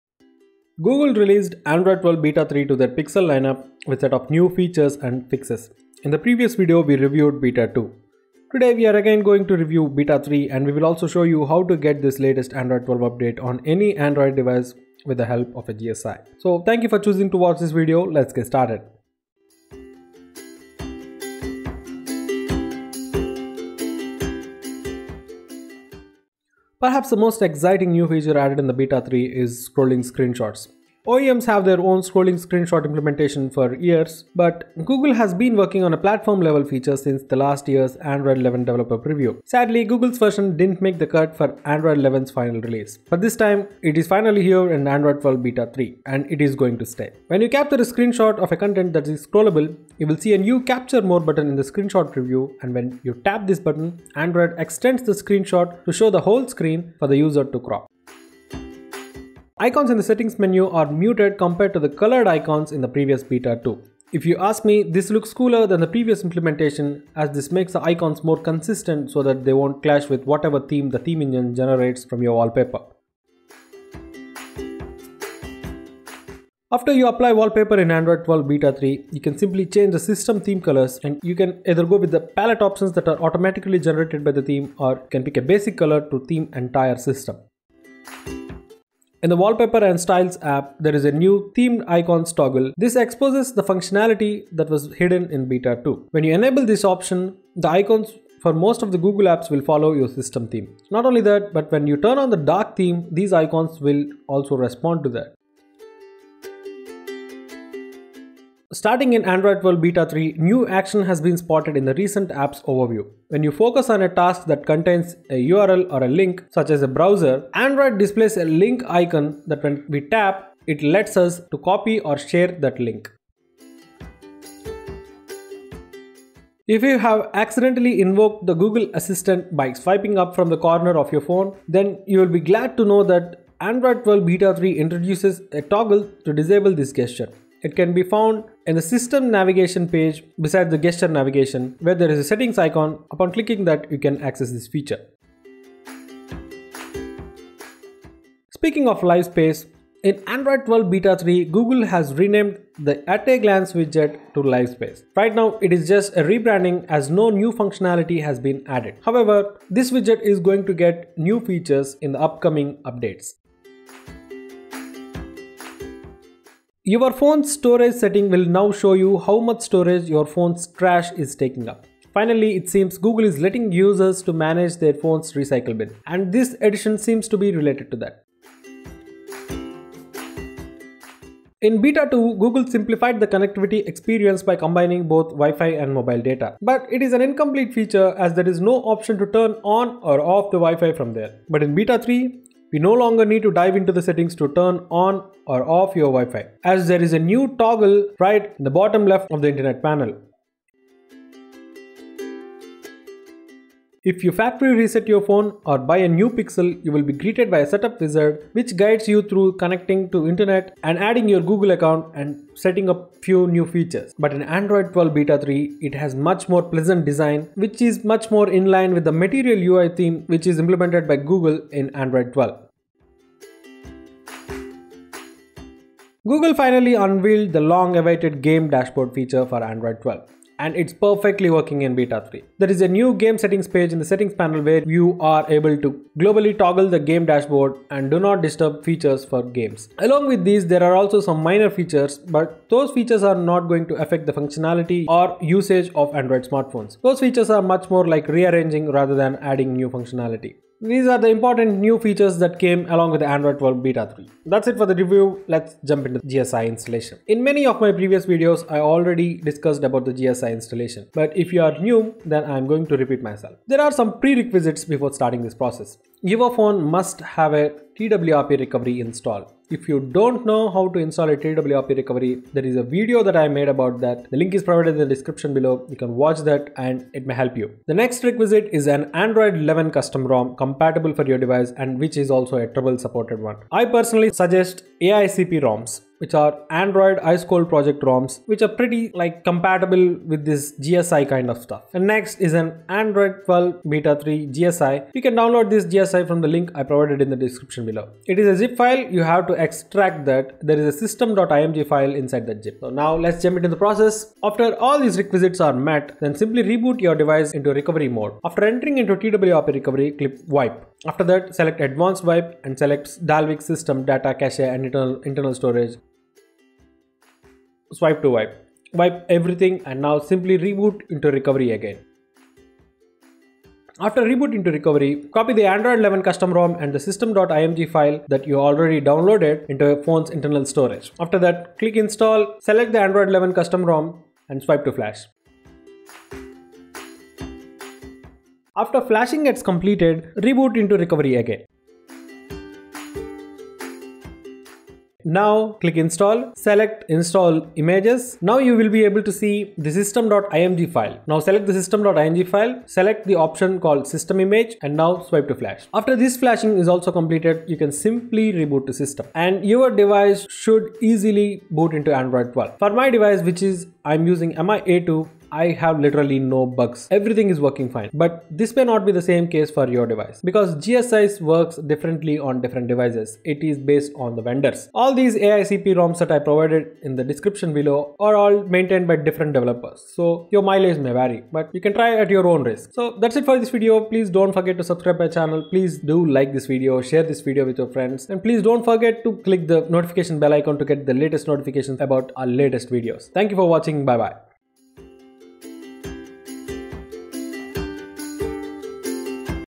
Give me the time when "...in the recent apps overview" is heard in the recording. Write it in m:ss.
1:51.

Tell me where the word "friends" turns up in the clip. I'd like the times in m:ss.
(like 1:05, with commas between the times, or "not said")
6:27.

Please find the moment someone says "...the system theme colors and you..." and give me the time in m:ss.
1:19.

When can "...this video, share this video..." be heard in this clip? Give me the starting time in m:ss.
6:26.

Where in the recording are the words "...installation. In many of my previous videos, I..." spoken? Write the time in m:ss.
4:16.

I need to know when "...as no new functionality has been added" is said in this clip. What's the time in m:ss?
2:36.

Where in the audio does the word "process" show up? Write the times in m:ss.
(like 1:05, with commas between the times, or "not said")
4:25, 5:03.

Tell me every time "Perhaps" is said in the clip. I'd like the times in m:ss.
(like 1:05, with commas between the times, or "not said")
0:26.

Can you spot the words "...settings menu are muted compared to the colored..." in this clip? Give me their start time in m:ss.
1:00.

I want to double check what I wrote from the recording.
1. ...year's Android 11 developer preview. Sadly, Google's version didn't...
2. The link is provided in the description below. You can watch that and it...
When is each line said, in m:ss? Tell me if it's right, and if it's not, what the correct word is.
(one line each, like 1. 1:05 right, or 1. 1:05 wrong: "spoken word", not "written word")
1. 0:37 right
2. 4:34 right.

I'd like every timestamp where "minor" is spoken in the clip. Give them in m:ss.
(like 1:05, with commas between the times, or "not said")
4:01.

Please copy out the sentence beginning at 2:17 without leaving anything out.
It can be found in the system navigation page beside the gesture navigation where there is a settings icon.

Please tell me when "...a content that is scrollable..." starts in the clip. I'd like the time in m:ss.
0:48.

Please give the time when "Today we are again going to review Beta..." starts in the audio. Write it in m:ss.
0:08.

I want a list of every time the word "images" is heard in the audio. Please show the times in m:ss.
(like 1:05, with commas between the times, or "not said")
5:47, 5:54.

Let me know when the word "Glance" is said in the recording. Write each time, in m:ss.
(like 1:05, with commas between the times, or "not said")
2:33.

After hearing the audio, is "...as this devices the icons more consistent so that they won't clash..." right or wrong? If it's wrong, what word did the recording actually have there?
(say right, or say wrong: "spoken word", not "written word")
wrong: "makes", not "devices".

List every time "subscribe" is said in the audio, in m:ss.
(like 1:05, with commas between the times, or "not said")
6:24.